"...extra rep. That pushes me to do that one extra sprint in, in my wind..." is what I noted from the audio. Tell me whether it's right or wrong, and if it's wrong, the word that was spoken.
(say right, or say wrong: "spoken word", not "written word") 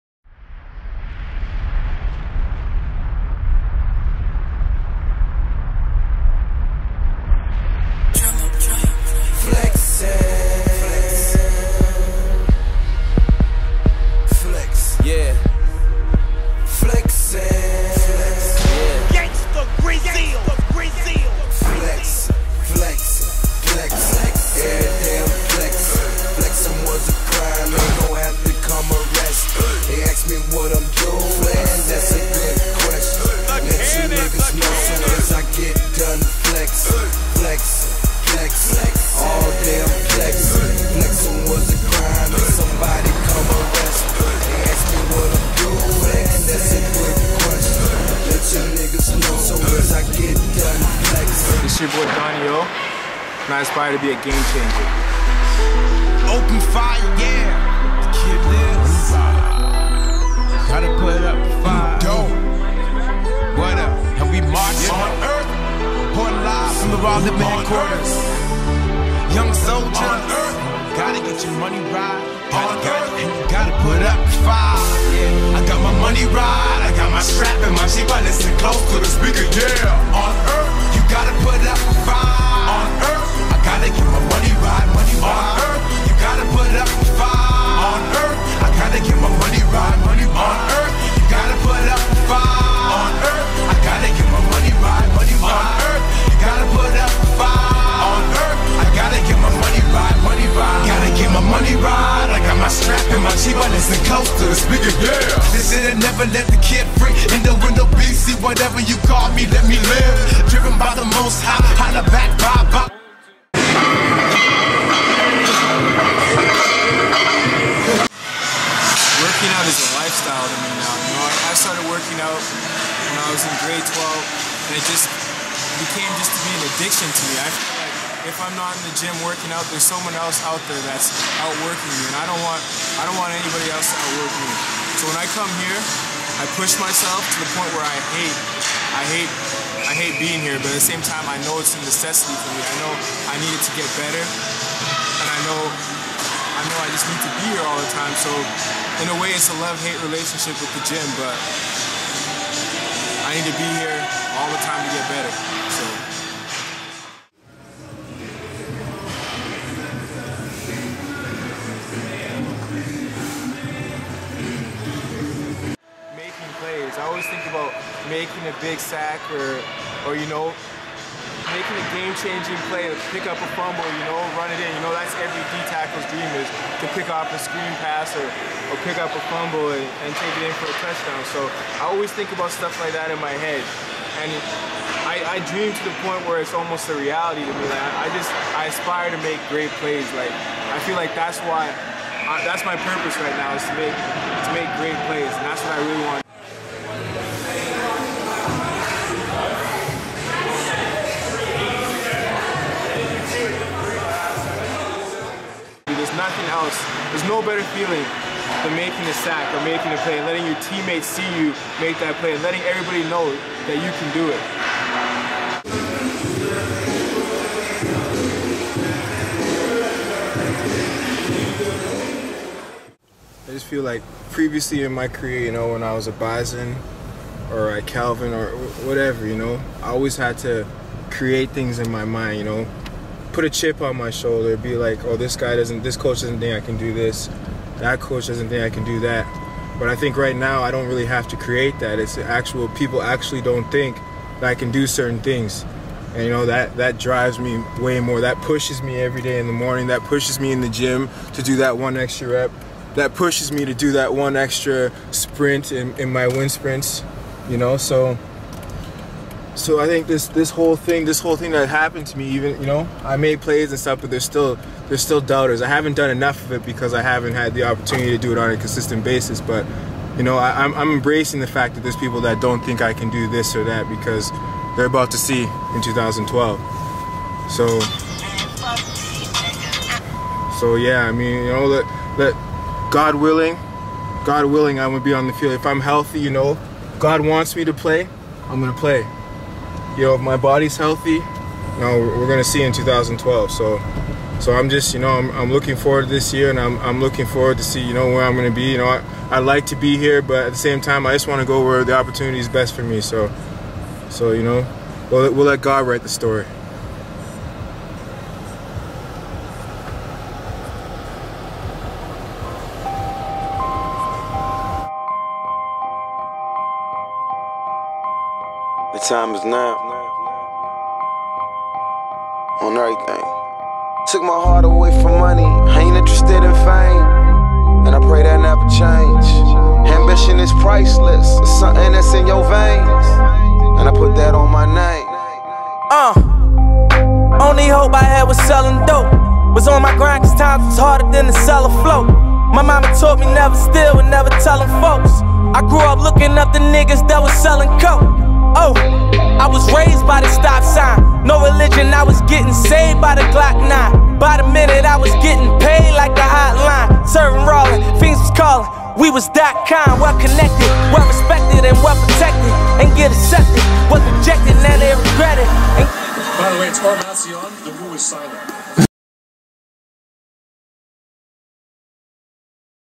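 right.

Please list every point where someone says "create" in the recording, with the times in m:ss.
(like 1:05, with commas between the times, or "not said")
3:51, 4:01.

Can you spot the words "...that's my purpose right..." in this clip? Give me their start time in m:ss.
3:12.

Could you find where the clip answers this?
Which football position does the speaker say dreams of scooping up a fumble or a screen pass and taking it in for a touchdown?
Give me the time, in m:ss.
2:55.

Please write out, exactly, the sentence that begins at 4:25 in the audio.
I haven't done enough of it because I haven't had the opportunity to do it on a consistent basis.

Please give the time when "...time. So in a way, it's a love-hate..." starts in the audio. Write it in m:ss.
2:27.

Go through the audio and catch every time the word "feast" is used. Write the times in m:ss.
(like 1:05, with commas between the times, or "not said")
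not said.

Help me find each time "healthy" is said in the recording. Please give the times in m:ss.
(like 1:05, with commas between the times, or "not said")
4:45, 4:50.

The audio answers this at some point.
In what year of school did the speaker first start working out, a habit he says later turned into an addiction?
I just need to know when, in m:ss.
2:03.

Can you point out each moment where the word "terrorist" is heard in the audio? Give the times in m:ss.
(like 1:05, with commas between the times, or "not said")
not said.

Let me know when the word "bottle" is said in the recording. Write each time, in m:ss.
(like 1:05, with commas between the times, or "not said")
not said.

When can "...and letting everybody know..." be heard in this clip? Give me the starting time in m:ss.
3:32.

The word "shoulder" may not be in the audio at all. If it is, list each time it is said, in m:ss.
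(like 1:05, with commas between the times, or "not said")
3:54.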